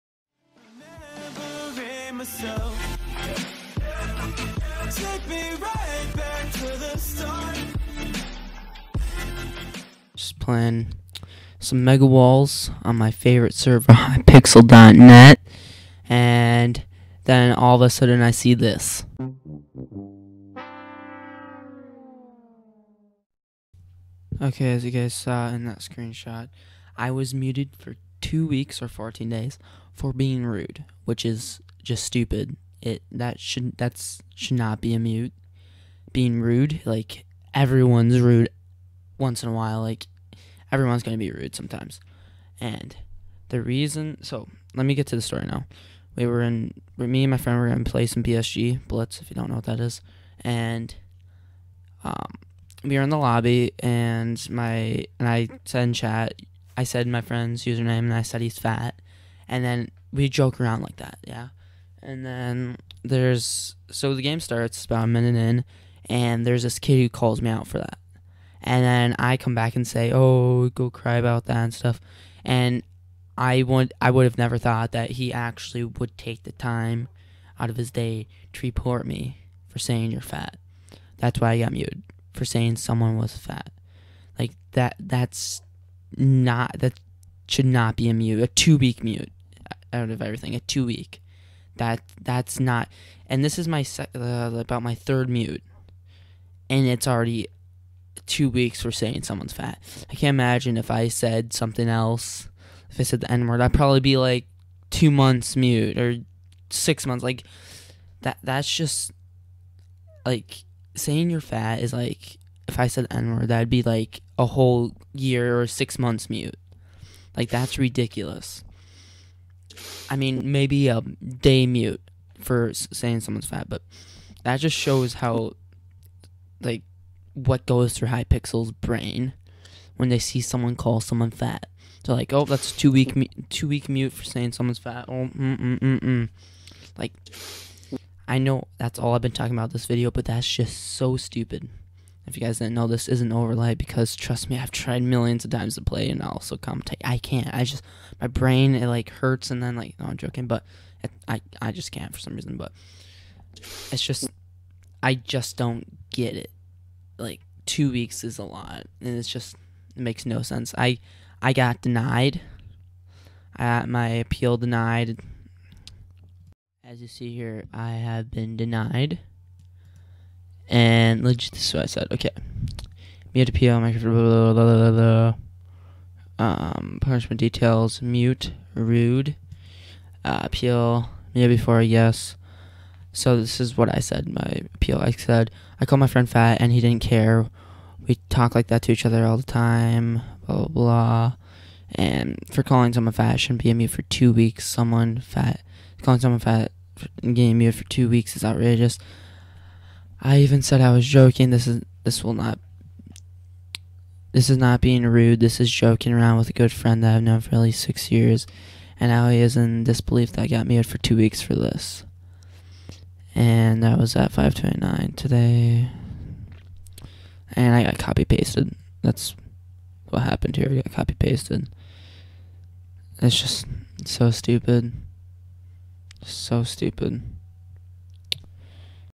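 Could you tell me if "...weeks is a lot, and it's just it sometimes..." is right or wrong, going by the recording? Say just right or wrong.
wrong.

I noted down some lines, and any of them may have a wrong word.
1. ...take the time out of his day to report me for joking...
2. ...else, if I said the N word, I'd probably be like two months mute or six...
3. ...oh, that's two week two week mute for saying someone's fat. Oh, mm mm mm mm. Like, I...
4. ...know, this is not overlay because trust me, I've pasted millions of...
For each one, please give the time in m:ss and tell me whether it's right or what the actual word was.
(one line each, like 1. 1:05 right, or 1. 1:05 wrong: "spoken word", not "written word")
1. 1:16 wrong: "saying", not "joking"
2. 1:41 right
3. 2:12 right
4. 2:22 wrong: "tried", not "pasted".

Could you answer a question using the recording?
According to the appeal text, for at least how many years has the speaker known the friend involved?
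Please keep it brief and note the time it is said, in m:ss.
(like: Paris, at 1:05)
6, at 3:27.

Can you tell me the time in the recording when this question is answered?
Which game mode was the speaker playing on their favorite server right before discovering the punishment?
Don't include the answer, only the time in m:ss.
0:11.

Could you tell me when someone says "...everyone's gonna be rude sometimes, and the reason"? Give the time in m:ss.
0:40.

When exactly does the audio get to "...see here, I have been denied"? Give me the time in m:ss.
2:47.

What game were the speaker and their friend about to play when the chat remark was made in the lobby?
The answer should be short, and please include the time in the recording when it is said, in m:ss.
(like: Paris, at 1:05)
BSG Blitz, at 0:48.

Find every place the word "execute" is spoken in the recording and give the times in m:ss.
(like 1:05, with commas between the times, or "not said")
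not said.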